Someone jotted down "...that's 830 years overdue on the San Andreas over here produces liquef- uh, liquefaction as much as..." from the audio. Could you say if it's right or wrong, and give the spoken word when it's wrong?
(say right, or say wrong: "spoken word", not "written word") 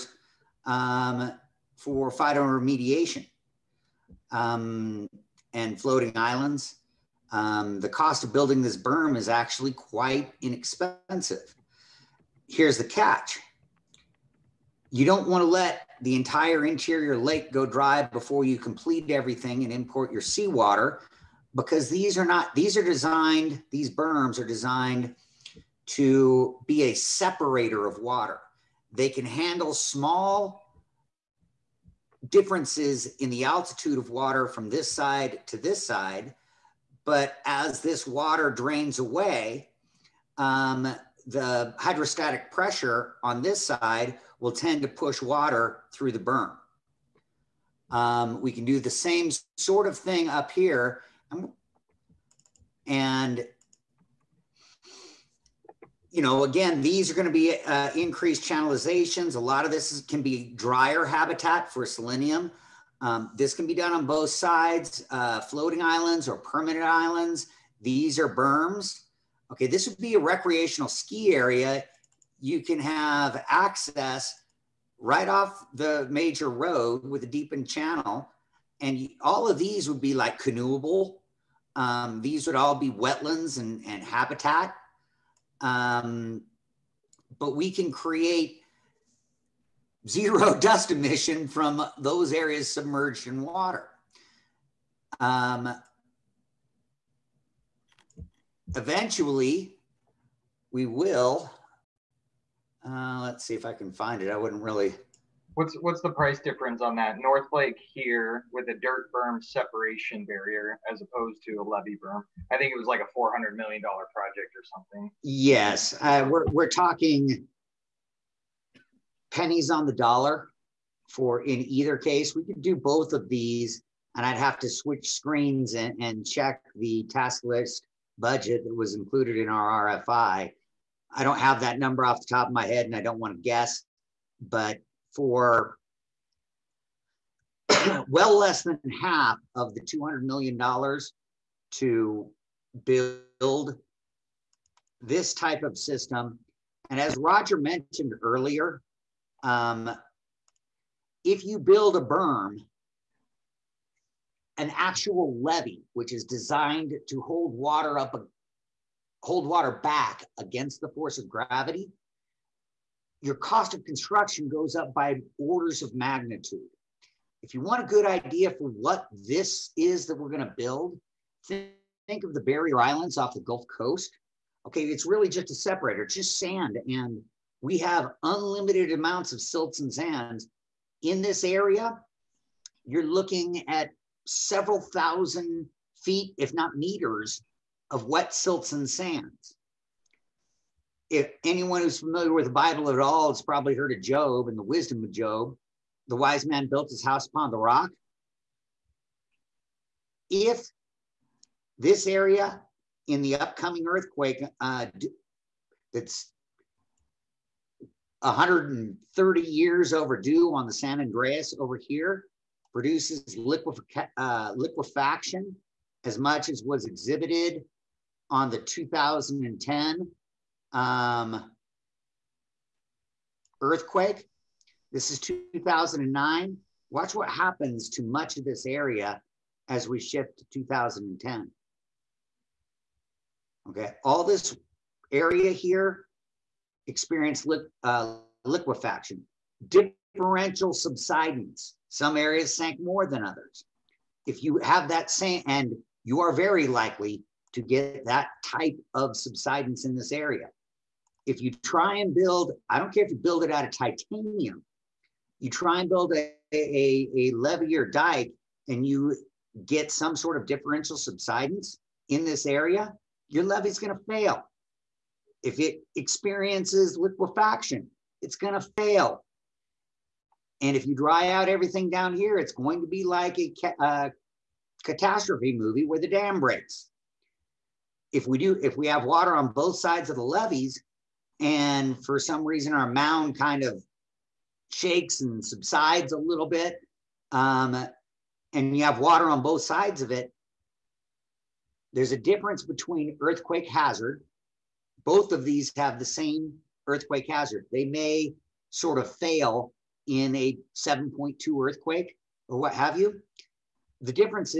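wrong: "130", not "830".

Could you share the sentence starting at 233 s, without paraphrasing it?
Okay, all this area here experienced li uh, liquefaction, differential subsidence.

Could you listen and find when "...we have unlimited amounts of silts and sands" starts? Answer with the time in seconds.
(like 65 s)
177 s.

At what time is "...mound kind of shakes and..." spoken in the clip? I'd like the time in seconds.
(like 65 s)
282 s.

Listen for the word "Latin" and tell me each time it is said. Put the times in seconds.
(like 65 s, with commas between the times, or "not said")
not said.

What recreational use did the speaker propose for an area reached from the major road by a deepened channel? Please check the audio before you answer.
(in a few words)
Ski area.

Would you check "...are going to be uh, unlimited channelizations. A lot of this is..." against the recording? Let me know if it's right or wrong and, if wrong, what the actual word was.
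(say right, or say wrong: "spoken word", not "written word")
wrong: "increased", not "unlimited".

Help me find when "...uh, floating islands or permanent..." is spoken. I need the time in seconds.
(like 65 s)
65 s.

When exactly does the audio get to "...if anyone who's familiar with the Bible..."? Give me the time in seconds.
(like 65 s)
191 s.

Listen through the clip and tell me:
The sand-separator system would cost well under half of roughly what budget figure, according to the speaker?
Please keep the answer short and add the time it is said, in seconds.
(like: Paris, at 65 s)
$200 million, at 139 s.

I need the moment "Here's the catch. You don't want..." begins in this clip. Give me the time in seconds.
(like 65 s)
12 s.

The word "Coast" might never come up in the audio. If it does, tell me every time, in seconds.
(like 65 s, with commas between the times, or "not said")
173 s.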